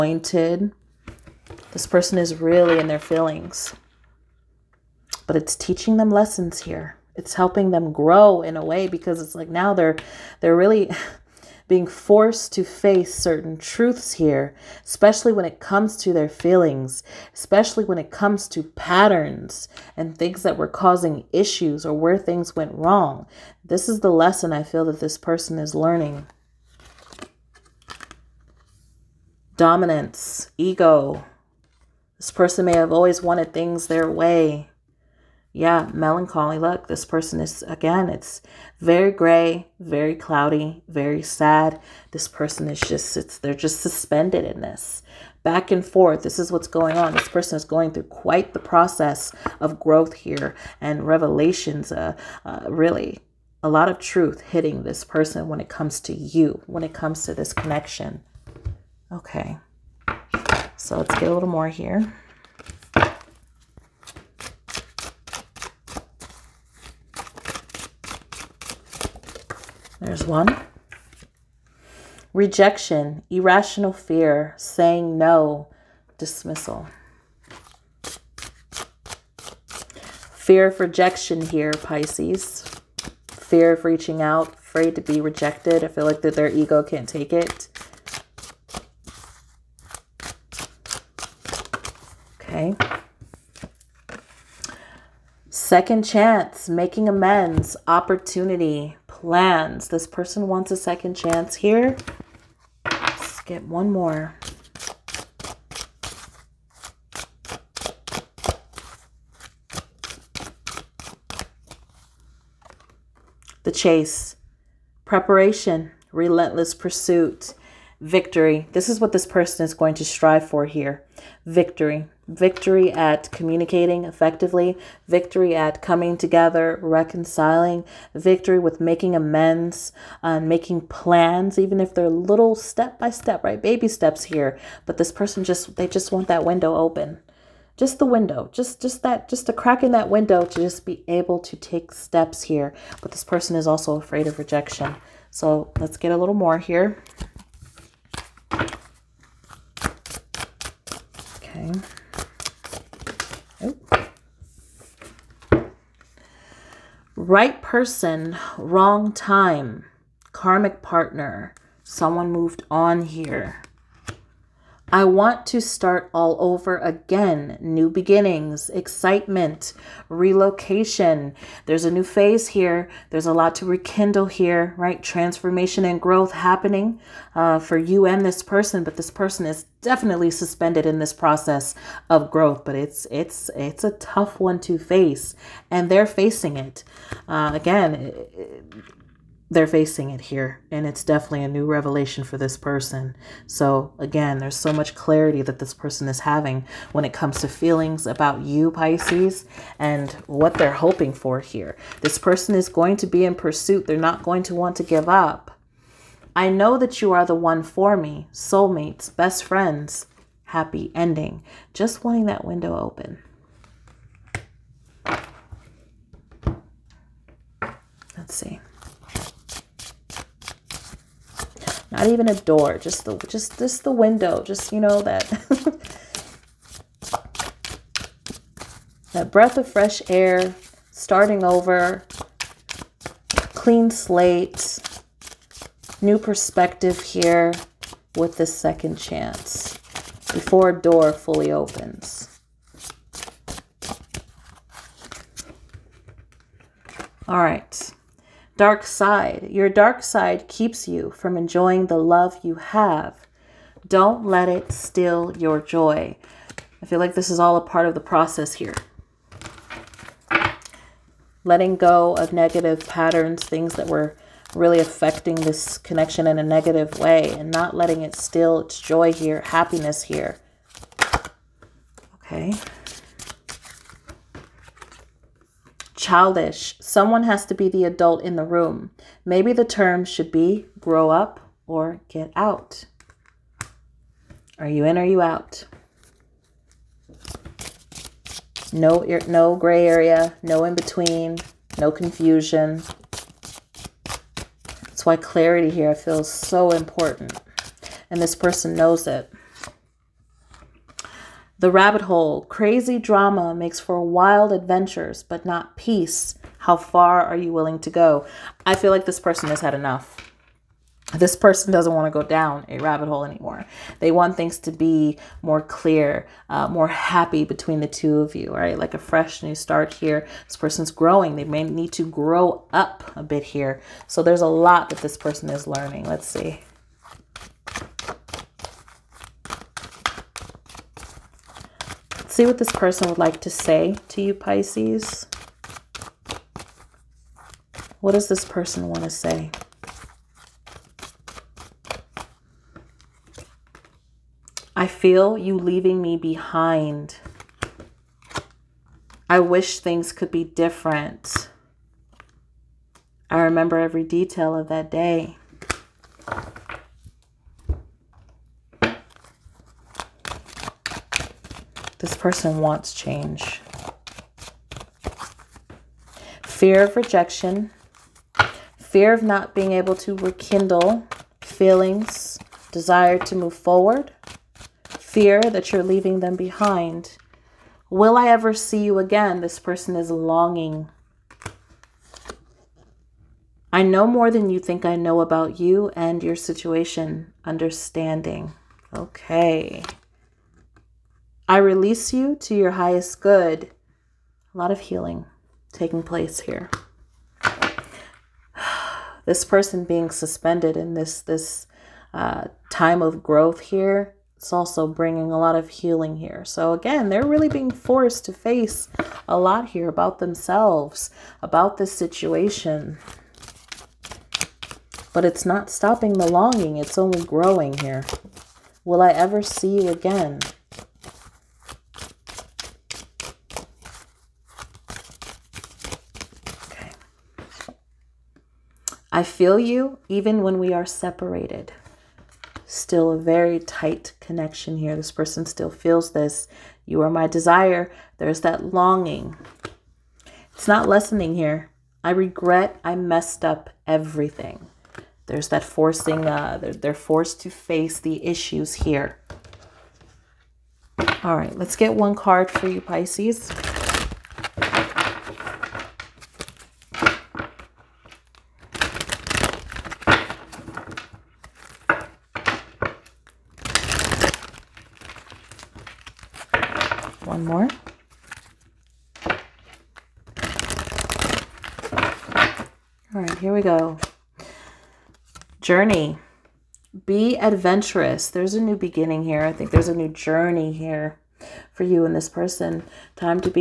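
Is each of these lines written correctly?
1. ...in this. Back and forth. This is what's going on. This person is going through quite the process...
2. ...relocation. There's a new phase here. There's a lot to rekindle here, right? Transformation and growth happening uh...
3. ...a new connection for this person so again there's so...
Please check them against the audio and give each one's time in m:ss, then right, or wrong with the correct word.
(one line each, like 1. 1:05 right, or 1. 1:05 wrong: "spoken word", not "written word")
1. 0:44 right
2. 2:50 right
3. 3:11 wrong: "revelation", not "connection".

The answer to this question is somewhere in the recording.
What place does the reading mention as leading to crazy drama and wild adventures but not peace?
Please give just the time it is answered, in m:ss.
5:01.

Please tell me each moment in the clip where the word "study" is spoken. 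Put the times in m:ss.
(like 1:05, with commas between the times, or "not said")
not said.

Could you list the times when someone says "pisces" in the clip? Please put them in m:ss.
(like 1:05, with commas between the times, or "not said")
1:21, 3:18, 5:34, 7:32.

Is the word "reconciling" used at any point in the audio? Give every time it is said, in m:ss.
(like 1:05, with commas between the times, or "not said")
2:06.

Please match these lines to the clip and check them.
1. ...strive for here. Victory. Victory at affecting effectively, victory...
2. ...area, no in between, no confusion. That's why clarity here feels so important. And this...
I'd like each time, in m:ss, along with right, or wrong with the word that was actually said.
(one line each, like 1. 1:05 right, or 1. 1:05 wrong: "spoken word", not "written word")
1. 2:00 wrong: "communicating", not "affecting"
2. 4:49 right.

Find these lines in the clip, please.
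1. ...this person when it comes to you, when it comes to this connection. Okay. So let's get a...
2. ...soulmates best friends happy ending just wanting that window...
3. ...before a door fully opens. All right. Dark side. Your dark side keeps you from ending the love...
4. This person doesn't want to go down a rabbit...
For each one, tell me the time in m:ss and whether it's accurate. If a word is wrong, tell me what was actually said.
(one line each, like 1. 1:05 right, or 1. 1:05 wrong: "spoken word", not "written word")
1. 0:54 right
2. 3:28 right
3. 4:00 wrong: "enjoying", not "ending"
4. 5:11 right.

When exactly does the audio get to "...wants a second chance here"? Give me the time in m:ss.
1:40.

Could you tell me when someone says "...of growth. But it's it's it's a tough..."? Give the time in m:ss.
3:02.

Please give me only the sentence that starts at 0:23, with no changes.
This is the lesson I feel that this person is learning.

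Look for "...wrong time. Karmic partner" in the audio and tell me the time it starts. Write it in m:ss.
2:38.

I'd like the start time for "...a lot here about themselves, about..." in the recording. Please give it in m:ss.
6:49.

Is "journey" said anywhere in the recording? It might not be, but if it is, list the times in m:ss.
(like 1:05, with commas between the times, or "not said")
7:55, 8:00.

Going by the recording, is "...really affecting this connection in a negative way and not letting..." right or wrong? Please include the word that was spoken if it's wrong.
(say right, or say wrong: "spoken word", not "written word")
right.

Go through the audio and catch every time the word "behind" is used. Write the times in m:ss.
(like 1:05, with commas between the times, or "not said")
5:46, 6:16.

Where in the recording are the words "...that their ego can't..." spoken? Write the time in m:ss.
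1:26.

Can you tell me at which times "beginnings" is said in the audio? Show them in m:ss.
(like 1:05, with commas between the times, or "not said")
2:47, 7:58.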